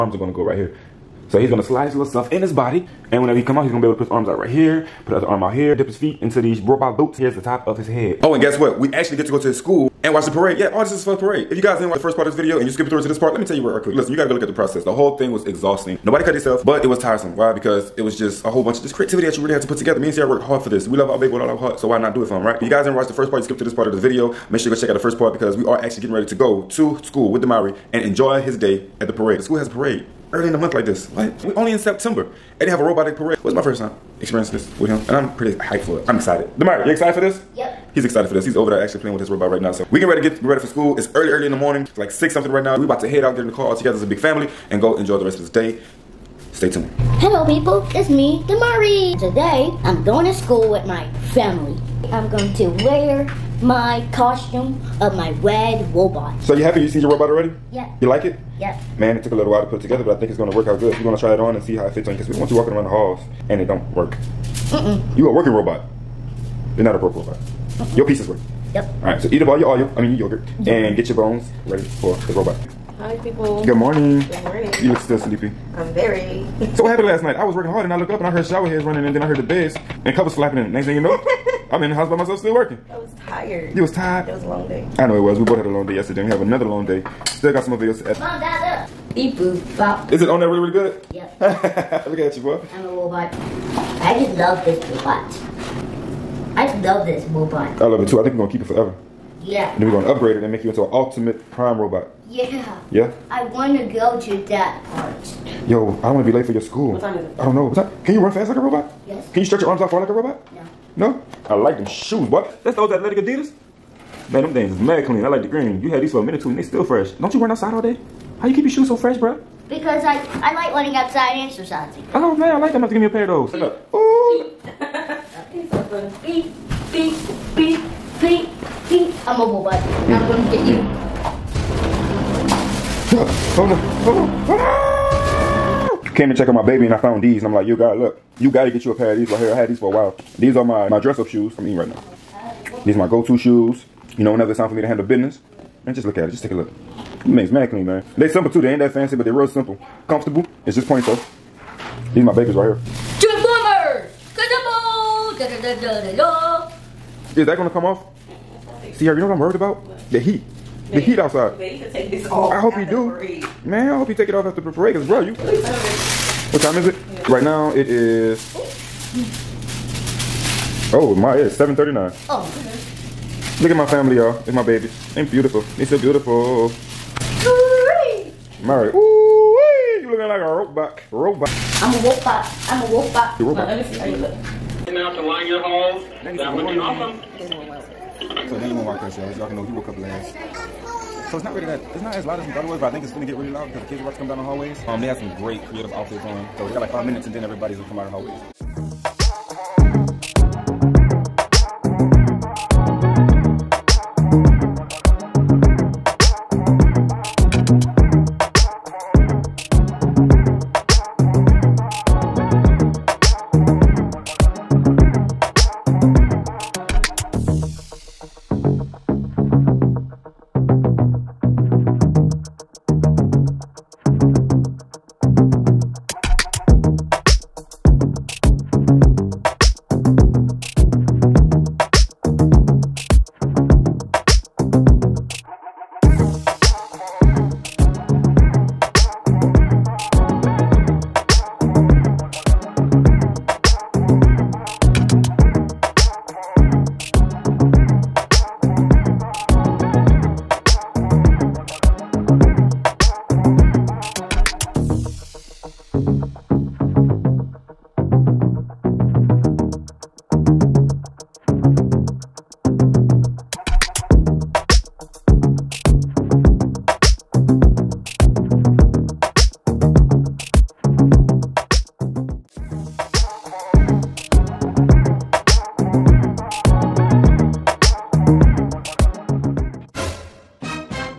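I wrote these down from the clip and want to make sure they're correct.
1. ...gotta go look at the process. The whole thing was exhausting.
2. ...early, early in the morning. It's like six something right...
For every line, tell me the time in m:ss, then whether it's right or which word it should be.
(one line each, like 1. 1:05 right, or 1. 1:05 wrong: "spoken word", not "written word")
1. 0:14 right
2. 0:41 right.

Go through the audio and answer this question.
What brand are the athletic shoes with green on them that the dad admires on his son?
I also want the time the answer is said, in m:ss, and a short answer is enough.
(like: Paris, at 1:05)
Adidas, at 1:53.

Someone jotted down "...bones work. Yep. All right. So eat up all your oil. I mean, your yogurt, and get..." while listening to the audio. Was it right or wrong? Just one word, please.
wrong.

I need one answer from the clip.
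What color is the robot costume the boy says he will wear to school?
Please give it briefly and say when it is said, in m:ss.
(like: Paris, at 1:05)
Red, at 0:55.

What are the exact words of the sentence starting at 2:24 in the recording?
You know, whenever it's time for me to handle business.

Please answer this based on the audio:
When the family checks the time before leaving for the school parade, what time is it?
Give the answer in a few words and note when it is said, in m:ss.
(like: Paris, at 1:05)
7:39, at 2:51.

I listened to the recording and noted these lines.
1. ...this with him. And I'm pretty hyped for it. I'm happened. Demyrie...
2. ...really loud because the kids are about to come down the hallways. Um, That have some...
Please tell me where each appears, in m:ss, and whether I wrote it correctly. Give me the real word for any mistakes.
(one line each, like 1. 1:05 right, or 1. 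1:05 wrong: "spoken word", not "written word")
1. 0:34 wrong: "excited", not "happened"
2. 3:13 wrong: "They", not "That".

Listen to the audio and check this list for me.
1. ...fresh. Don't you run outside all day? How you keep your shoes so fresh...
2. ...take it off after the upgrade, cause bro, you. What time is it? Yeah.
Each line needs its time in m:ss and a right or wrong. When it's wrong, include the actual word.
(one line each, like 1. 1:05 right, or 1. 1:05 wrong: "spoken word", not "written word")
1. 1:56 right
2. 2:44 wrong: "parade", not "upgrade".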